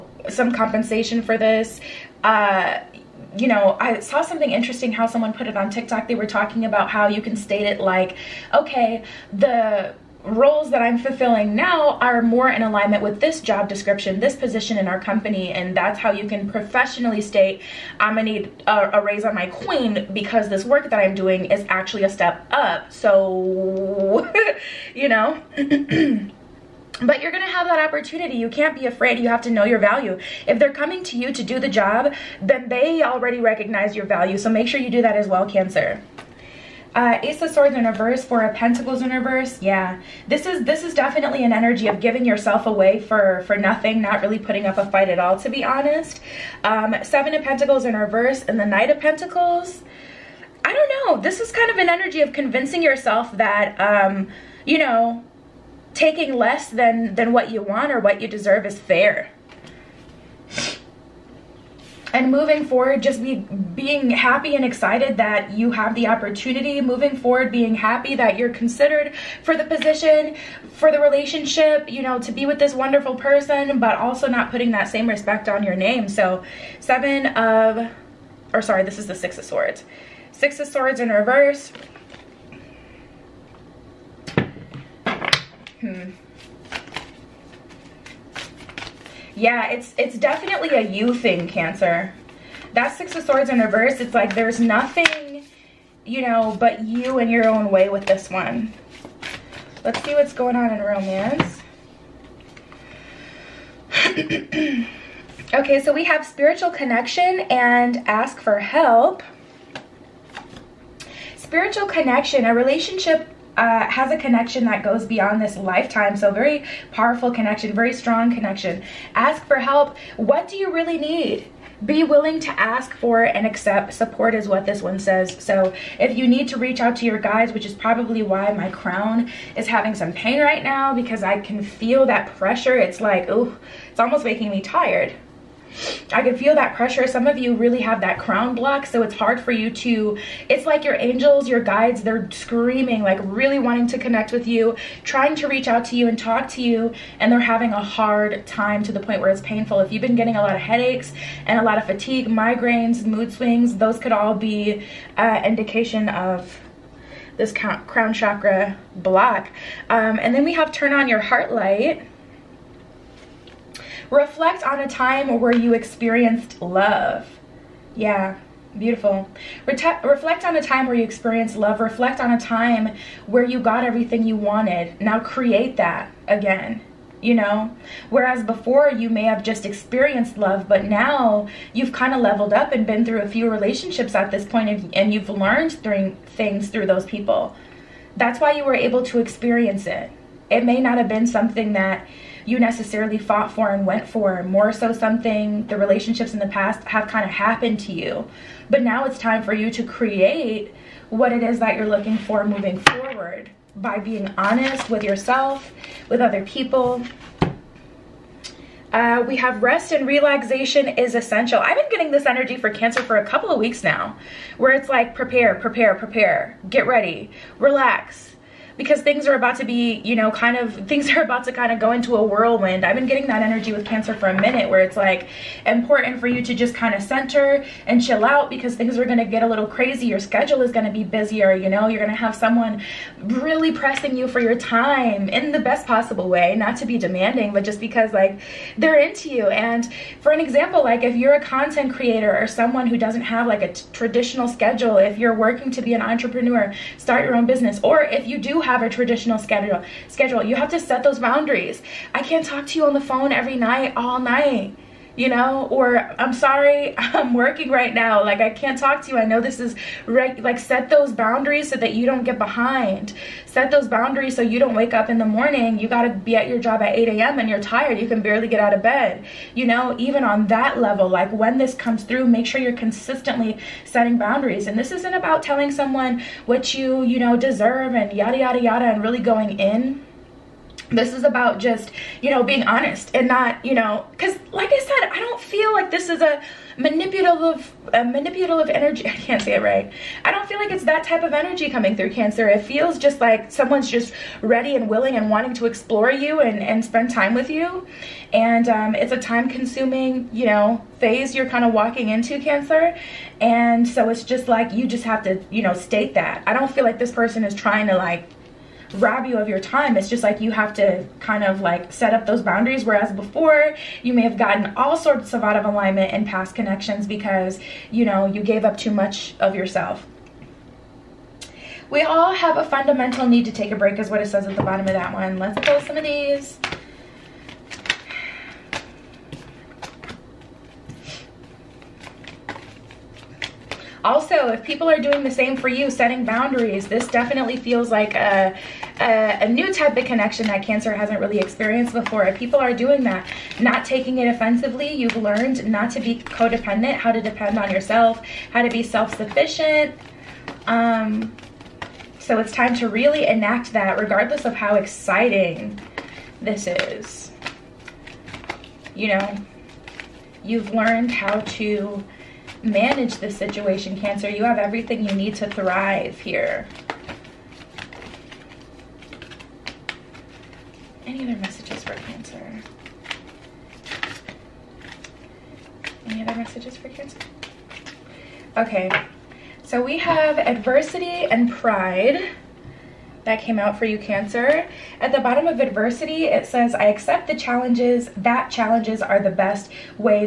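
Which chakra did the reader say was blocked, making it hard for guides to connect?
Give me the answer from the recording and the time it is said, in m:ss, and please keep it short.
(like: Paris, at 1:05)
Crown chakra, at 2:37.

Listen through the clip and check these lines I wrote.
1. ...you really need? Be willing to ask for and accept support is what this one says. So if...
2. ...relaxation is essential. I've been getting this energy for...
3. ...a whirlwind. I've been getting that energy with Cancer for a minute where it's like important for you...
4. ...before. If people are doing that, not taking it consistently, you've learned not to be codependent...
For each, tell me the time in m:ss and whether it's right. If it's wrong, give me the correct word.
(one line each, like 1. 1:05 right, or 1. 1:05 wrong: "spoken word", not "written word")
1. 2:00 right
2. 3:30 right
3. 3:42 right
4. 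5:41 wrong: "offensively", not "consistently".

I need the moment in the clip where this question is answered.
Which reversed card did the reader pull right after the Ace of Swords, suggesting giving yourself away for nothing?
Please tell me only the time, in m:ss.
0:38.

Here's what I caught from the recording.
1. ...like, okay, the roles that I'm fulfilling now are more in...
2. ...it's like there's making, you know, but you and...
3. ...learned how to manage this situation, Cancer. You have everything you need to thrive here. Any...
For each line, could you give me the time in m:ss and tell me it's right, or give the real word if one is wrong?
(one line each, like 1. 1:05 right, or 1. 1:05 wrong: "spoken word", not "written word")
1. 0:07 right
2. 1:33 wrong: "nothing", not "making"
3. 6:00 right.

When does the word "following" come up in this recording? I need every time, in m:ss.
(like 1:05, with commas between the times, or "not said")
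not said.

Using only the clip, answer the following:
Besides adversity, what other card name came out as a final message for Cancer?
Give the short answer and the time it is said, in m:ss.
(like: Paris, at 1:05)
Pride, at 6:21.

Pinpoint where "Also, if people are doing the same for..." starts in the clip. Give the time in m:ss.
5:34.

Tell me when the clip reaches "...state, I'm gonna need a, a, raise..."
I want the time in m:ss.
0:17.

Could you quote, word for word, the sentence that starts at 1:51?
Spiritual connection, a relationship uh, has a connection that goes beyond this lifetime.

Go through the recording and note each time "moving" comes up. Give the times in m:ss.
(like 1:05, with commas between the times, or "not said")
1:02, 1:06, 3:22.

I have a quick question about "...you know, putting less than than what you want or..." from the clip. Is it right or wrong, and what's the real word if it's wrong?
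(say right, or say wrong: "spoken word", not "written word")
wrong: "taking", not "putting".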